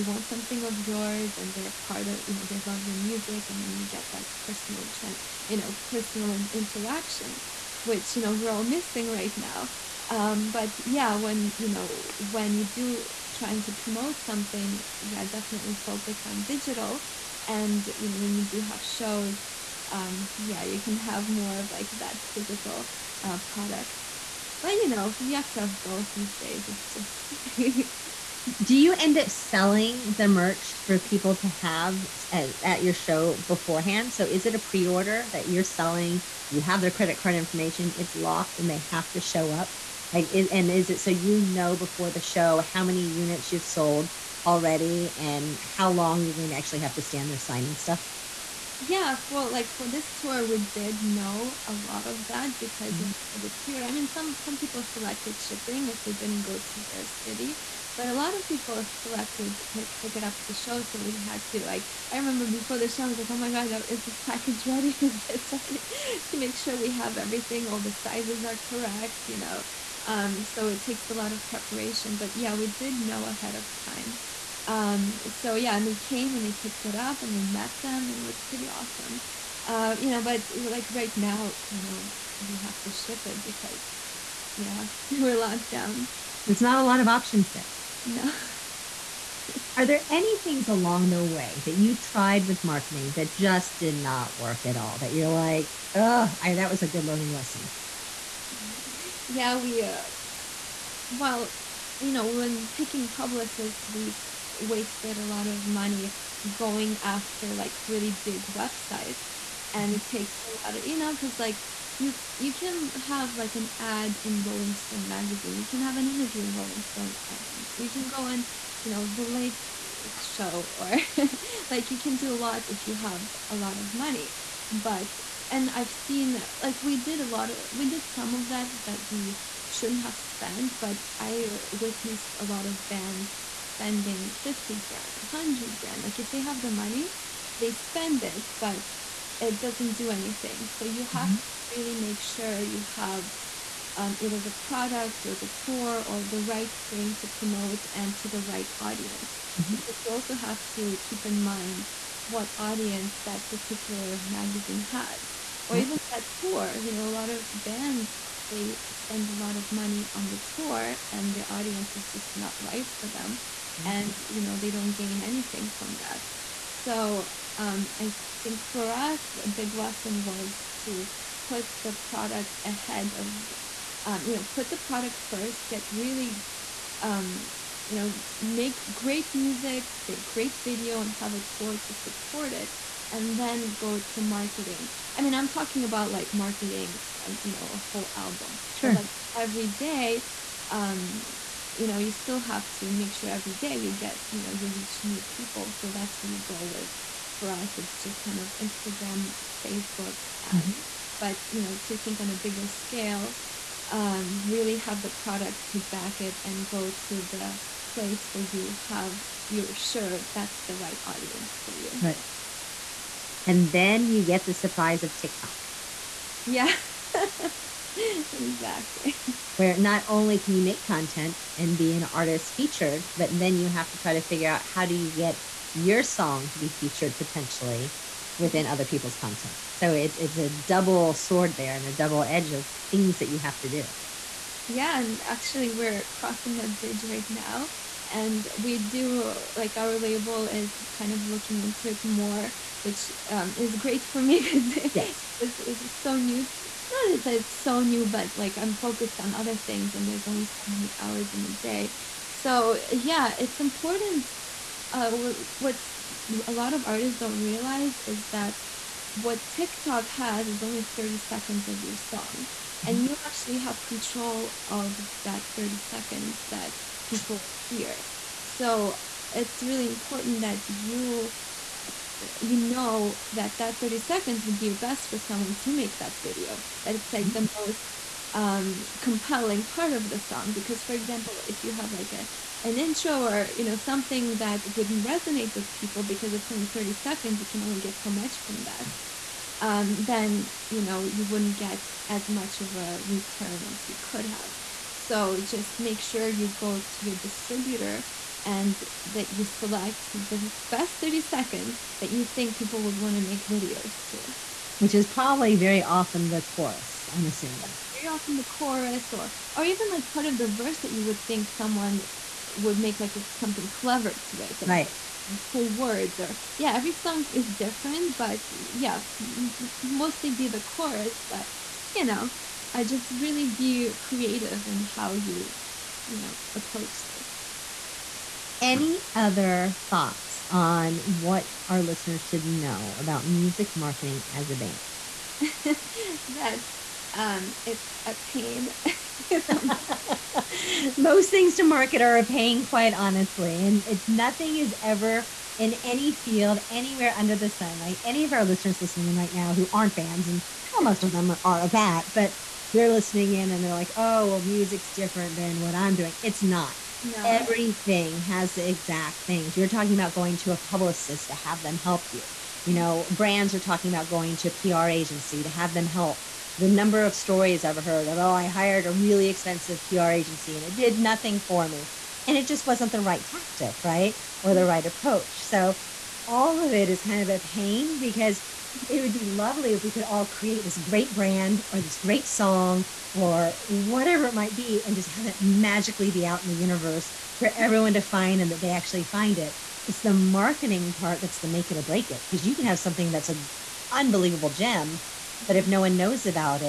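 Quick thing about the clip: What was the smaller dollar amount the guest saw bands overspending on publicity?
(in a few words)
50 grand.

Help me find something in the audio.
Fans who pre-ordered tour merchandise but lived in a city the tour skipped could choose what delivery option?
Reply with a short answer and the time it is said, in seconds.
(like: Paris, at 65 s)
Shipping, at 55 s.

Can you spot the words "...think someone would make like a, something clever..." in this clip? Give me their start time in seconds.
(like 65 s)
311 s.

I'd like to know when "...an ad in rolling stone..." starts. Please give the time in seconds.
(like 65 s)
113 s.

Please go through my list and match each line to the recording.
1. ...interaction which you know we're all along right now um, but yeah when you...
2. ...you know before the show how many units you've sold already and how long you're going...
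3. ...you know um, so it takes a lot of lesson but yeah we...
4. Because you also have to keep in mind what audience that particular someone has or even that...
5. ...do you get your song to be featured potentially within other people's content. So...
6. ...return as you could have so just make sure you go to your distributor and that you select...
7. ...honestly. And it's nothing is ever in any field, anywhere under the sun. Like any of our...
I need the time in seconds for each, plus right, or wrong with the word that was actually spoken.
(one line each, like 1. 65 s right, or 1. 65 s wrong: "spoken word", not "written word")
1. 6 s wrong: "missing", not "along"
2. 41 s right
3. 69 s wrong: "preparation", not "lesson"
4. 149 s wrong: "magazine", not "someone"
5. 224 s right
6. 293 s right
7. 342 s right.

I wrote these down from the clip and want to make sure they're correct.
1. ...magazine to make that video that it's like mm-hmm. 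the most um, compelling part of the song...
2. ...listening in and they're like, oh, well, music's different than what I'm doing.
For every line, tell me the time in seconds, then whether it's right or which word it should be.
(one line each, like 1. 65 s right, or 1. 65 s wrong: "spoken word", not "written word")
1. 275 s wrong: "someone", not "magazine"
2. 352 s right.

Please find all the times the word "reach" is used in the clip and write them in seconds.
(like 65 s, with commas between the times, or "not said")
194 s.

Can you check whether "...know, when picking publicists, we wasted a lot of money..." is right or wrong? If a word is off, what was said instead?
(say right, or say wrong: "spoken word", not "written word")
right.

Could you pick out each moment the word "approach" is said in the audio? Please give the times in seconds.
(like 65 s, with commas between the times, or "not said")
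326 s, 374 s.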